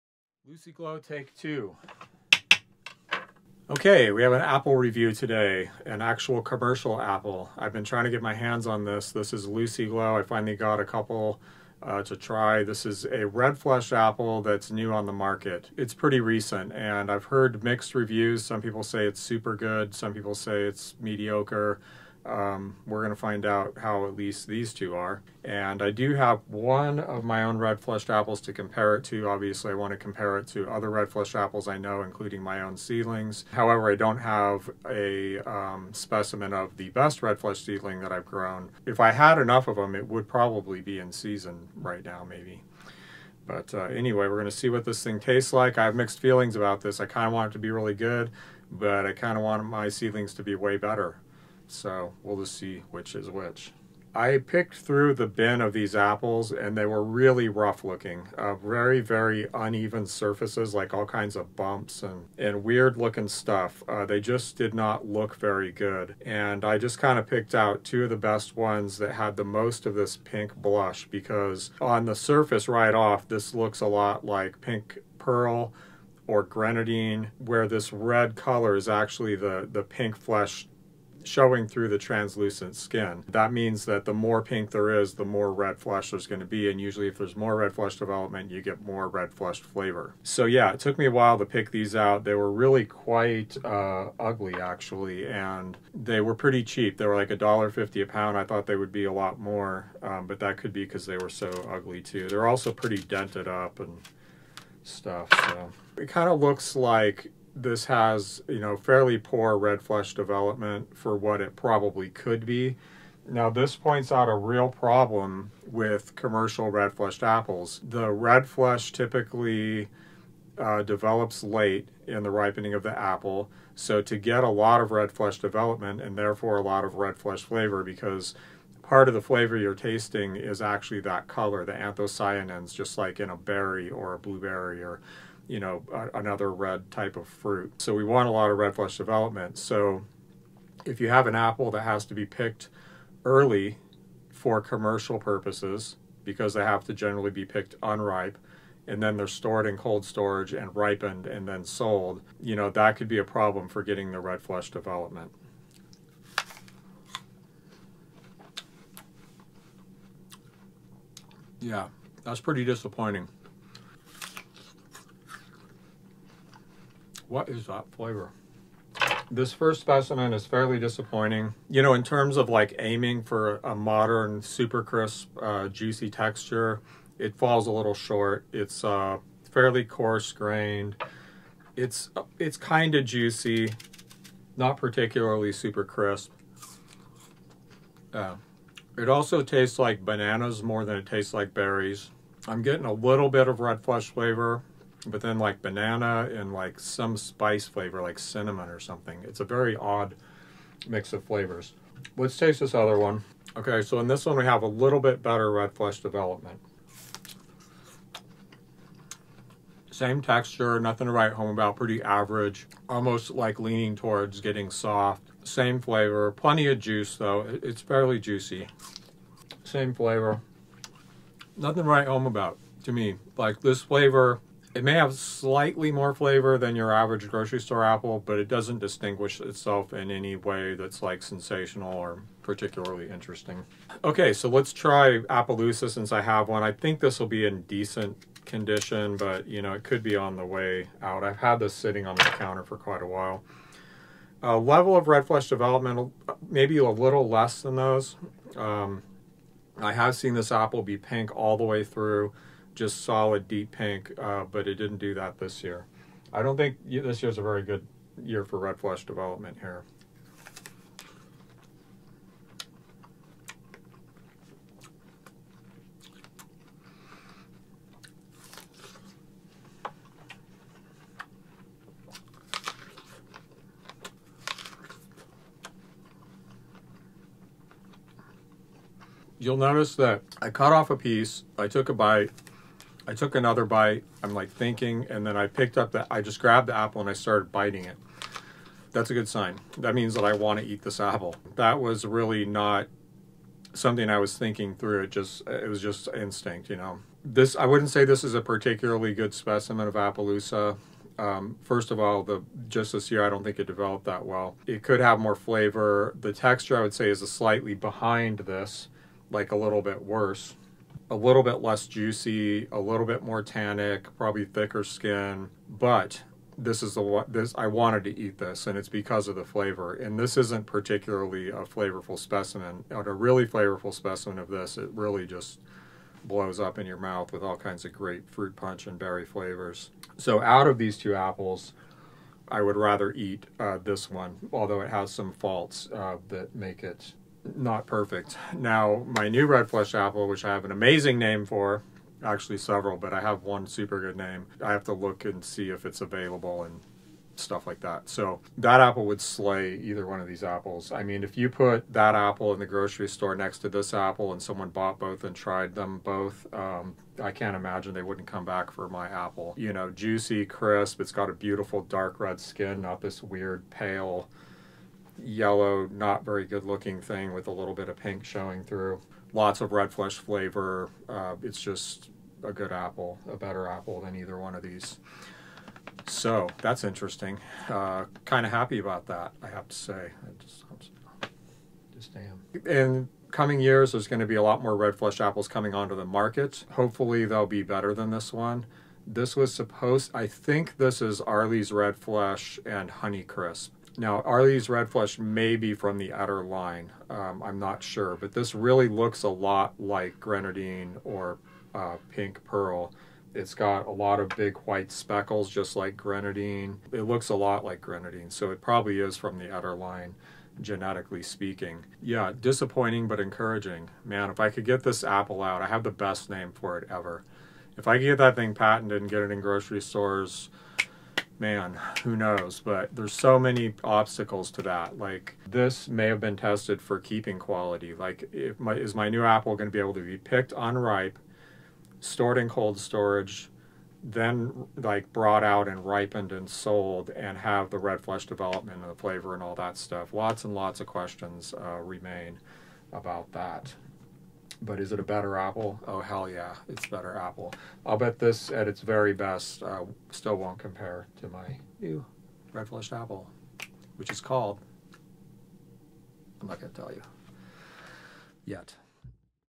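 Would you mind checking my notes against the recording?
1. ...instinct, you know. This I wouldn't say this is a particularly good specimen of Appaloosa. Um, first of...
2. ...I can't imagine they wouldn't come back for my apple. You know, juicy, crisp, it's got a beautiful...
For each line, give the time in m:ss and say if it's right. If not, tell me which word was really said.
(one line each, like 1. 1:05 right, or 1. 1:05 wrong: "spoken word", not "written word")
1. 4:56 right
2. 5:57 right.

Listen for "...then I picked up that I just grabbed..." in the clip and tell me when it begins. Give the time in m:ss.
4:45.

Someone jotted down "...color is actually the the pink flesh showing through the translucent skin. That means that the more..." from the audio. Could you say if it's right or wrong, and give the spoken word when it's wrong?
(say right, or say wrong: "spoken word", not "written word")
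right.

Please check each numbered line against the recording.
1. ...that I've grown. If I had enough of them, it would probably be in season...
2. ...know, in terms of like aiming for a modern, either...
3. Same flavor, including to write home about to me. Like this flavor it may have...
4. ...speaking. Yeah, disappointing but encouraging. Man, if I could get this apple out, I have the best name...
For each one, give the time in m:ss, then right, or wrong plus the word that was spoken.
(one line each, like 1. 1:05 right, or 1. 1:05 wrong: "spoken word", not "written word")
1. 0:38 right
2. 2:51 wrong: "super", not "either"
3. 3:39 wrong: "nothing", not "including"
4. 6:51 right.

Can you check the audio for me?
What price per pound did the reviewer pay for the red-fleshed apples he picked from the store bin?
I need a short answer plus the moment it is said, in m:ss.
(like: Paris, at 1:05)
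$1.50, at 1:37.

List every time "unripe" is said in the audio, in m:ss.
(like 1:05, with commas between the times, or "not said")
2:27, 7:10.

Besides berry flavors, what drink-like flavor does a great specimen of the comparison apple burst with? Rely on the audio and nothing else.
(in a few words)
Fruit punch.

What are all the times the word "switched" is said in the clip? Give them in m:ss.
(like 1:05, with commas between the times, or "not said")
not said.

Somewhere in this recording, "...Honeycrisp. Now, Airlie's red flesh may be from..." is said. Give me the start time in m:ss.
6:32.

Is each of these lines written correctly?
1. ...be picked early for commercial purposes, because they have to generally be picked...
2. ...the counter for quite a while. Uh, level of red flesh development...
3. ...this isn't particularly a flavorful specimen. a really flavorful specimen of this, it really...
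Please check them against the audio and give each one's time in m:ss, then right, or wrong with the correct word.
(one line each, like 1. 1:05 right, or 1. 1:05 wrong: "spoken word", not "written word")
1. 2:22 right
2. 4:02 right
3. 5:20 right.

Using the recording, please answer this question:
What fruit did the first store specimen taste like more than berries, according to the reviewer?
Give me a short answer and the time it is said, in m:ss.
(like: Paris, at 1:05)
Bananas, at 3:10.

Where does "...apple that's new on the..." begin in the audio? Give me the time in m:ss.
0:13.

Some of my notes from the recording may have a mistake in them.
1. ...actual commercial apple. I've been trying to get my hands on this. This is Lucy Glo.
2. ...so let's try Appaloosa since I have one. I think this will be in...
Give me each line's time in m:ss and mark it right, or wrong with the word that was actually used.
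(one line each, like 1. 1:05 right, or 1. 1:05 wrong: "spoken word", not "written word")
1. 0:06 right
2. 3:54 right.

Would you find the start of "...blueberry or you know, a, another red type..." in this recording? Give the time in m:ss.
2:14.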